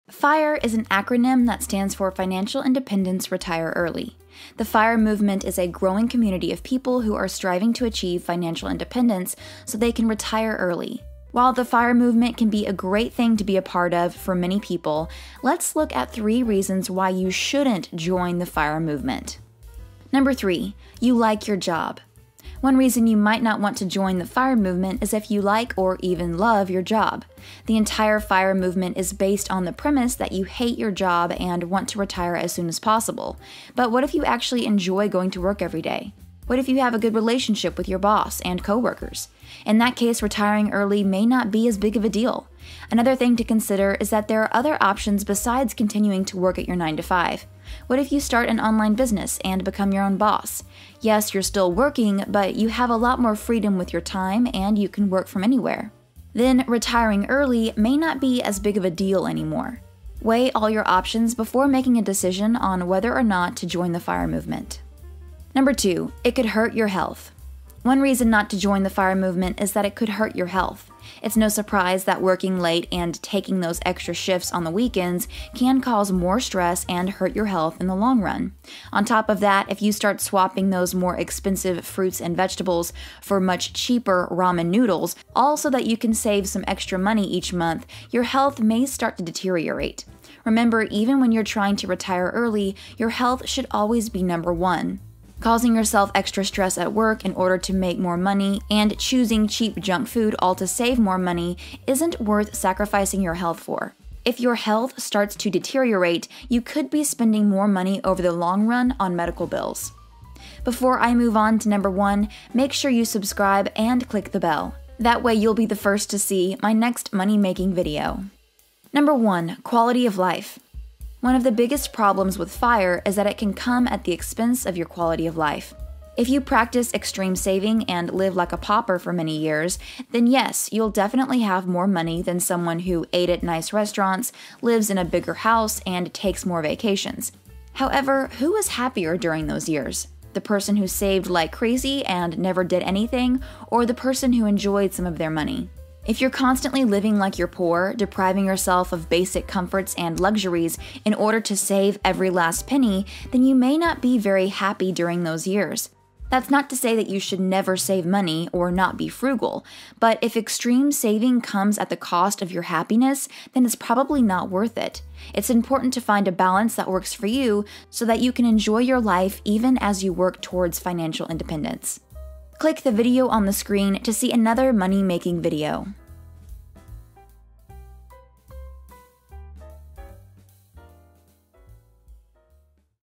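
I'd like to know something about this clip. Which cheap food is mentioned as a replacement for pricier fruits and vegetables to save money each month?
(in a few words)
Ramen noodles.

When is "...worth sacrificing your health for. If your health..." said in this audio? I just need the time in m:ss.
1:42.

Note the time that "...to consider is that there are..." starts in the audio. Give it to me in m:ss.
0:43.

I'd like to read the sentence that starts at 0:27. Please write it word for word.
The entire fire movement is based on the premise that you hate your job and want to retire as soon as possible.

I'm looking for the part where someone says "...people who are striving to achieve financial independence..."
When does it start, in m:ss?
0:06.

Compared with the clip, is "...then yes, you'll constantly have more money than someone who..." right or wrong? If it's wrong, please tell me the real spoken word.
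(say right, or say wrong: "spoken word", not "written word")
wrong: "definitely", not "constantly".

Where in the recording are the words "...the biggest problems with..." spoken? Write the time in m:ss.
2:01.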